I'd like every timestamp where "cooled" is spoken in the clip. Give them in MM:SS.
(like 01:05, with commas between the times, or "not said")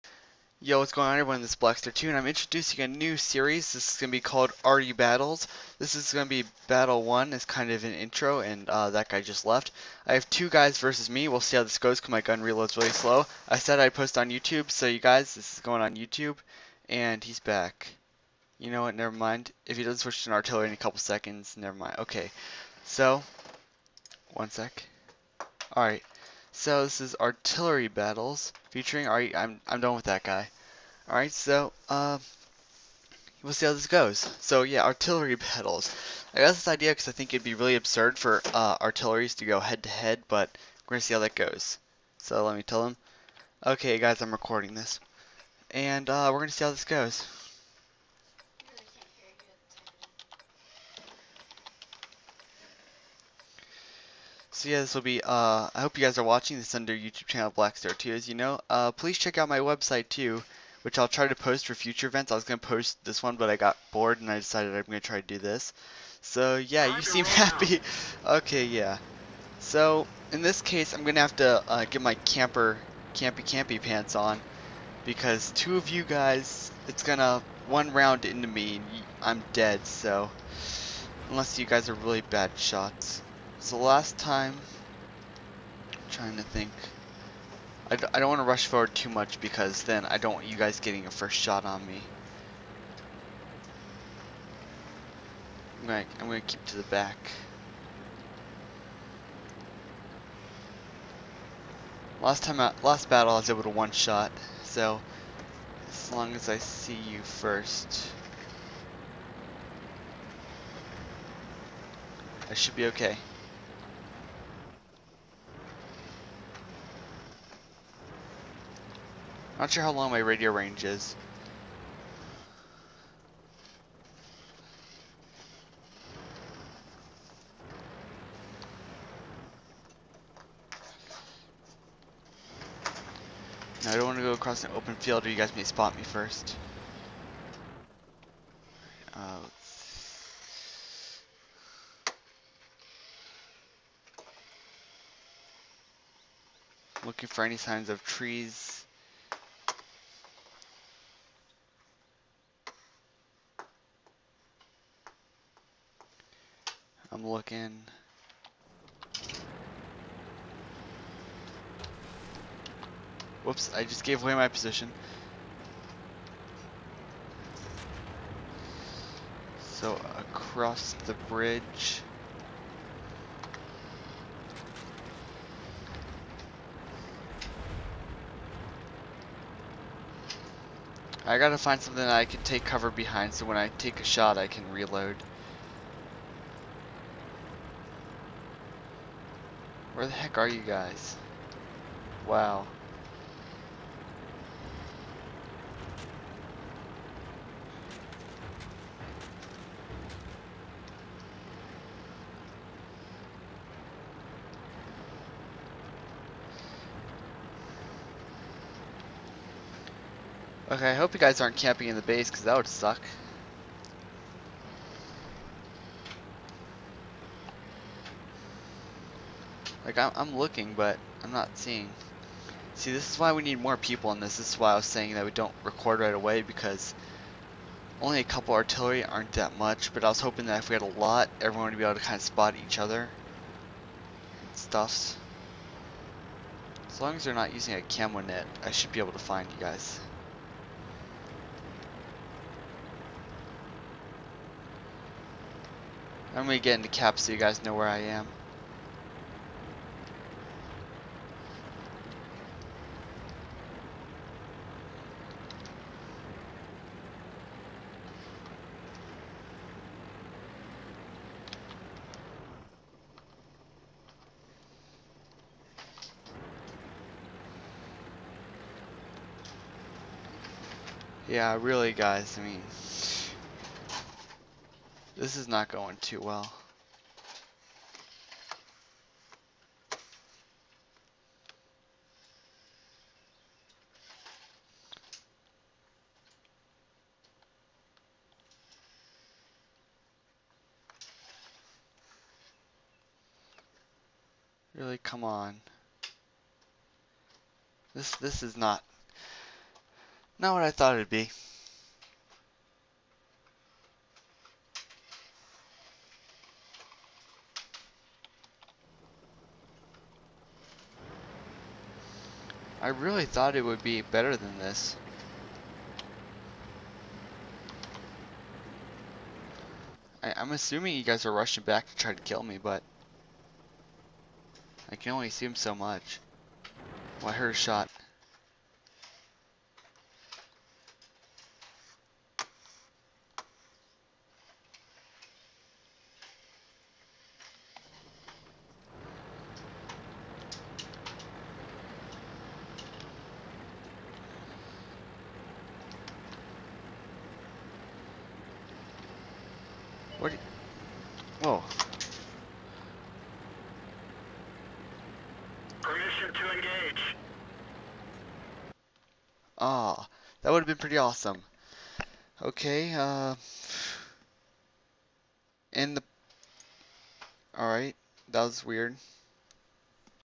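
not said.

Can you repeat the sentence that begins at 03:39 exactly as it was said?
Like, I'm, I'm looking, but I'm not seeing.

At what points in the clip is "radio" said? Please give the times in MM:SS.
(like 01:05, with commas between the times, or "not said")
02:00.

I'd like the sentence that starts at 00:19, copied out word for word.
If he doesn't switch to an artillery in a couple seconds, never mind.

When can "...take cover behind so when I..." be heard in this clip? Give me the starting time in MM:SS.
03:02.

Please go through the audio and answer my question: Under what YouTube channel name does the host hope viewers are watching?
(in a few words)
Blackstarre 2.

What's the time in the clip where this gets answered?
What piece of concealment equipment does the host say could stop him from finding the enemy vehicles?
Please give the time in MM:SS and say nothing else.
03:57.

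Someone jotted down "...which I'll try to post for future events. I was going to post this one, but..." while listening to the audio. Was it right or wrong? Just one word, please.
right.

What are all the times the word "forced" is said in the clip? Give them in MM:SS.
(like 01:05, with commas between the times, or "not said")
not said.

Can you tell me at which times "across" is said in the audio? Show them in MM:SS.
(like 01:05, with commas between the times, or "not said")
02:14, 02:50.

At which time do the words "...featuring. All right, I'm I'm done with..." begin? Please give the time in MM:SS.
00:28.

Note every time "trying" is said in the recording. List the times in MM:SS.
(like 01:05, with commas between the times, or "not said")
01:26.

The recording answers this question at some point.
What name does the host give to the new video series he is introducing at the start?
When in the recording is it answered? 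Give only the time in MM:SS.
00:04.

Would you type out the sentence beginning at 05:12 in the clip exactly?
I really thought it would be better than this.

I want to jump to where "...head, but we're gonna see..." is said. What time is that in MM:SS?
00:39.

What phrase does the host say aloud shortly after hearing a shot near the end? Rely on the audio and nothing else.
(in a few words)
Permission to engage.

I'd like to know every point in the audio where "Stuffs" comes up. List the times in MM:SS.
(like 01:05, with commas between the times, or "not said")
03:54.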